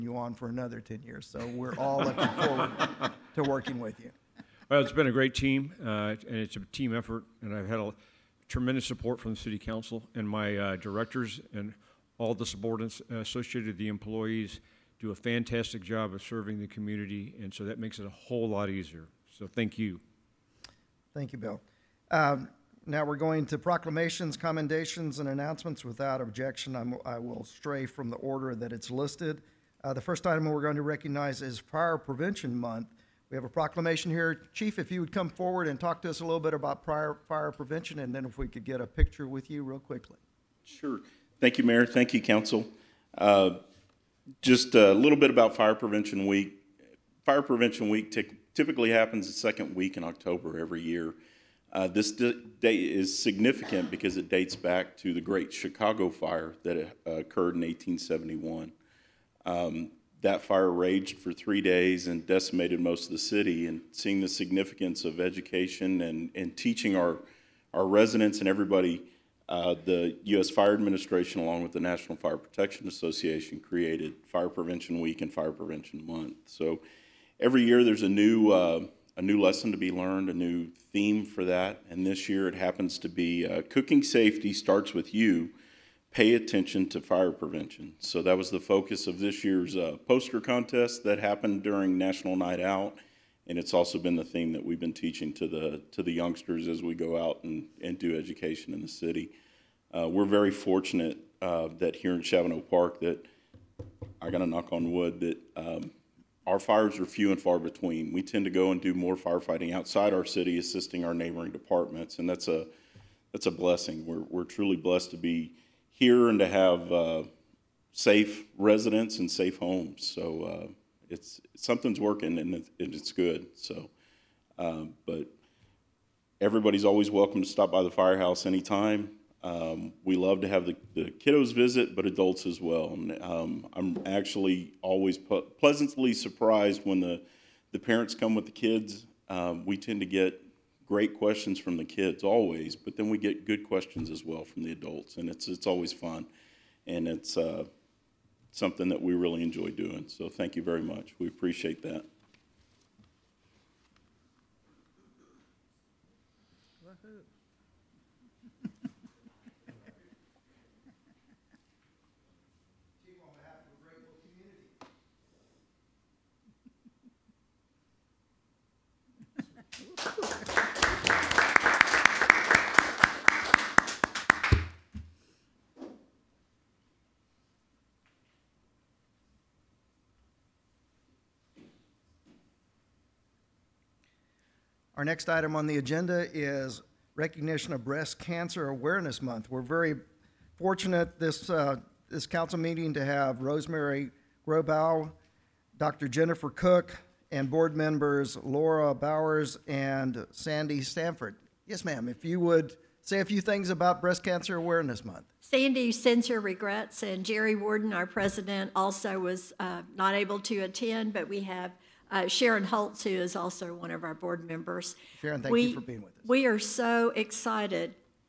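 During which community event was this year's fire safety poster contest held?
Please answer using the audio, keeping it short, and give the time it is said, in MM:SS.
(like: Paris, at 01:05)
National Night Out, at 01:31.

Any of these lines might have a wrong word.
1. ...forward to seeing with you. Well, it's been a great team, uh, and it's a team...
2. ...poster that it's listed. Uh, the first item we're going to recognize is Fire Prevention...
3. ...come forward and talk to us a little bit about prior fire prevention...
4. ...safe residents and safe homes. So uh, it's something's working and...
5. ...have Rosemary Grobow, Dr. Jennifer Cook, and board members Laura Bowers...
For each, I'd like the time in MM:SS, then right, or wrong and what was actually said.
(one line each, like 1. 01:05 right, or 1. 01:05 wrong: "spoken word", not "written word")
1. 00:02 wrong: "working", not "seeing"
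2. 00:28 wrong: "order", not "poster"
3. 00:35 right
4. 01:57 right
5. 03:13 right.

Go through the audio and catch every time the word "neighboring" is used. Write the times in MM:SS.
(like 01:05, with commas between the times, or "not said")
01:51.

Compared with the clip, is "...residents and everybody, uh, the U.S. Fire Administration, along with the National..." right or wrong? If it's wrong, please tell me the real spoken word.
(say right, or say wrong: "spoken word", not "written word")
right.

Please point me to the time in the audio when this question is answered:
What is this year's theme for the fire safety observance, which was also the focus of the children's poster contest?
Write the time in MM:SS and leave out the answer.
01:23.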